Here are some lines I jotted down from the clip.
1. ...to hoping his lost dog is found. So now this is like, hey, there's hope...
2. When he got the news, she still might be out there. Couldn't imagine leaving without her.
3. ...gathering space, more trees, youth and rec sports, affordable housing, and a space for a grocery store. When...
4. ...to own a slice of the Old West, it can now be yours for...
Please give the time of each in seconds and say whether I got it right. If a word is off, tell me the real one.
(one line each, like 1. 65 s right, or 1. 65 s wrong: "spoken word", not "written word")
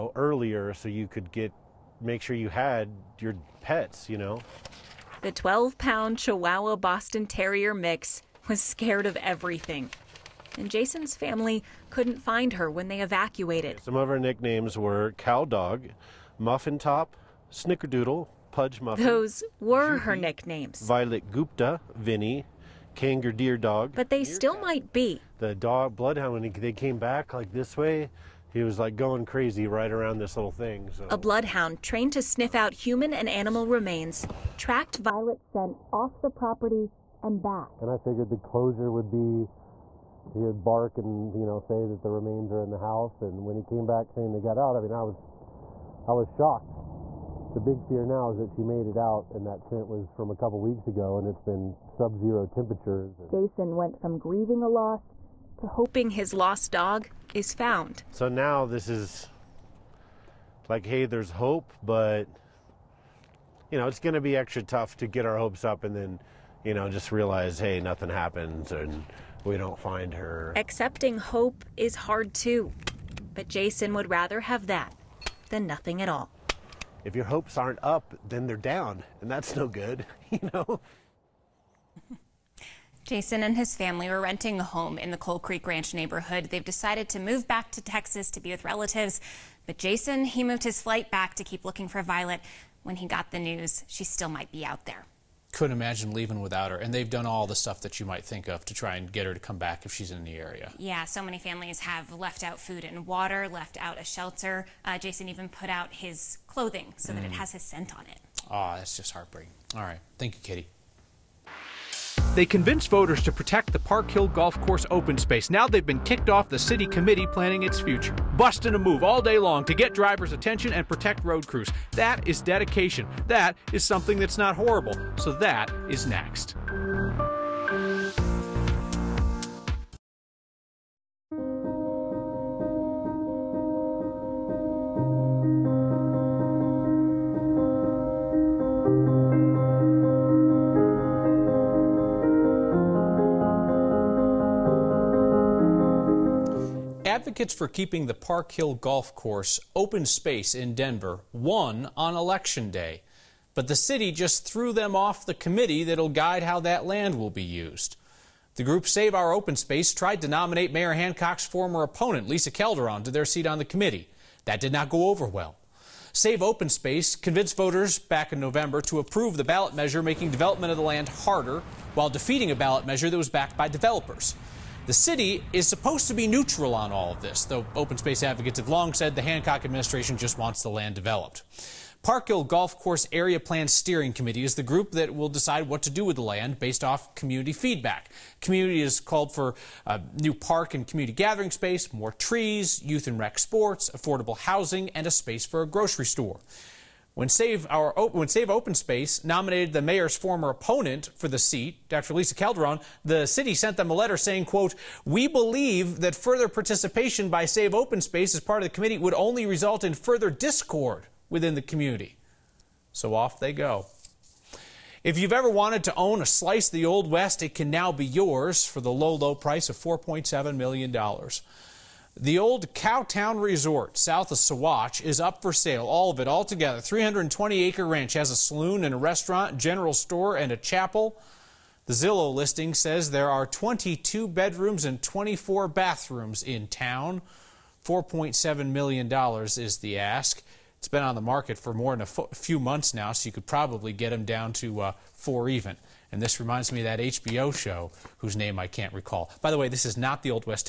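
1. 55 s right
2. 92 s right
3. 191 s right
4. 215 s right.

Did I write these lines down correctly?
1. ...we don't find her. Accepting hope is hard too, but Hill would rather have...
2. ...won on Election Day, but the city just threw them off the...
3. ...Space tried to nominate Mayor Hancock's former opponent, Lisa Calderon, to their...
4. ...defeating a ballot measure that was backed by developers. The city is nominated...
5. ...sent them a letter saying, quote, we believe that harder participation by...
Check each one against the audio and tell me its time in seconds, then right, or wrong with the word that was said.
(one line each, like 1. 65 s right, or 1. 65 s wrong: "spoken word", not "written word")
1. 69 s wrong: "Jason", not "Hill"
2. 151 s right
3. 159 s right
4. 172 s wrong: "supposed", not "nominated"
5. 203 s wrong: "further", not "harder".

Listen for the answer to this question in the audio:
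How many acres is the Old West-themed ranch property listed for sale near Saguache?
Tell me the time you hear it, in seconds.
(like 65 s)
226 s.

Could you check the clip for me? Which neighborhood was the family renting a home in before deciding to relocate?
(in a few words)
Coal Creek Ranch.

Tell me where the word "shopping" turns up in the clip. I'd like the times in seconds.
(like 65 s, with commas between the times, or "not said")
not said.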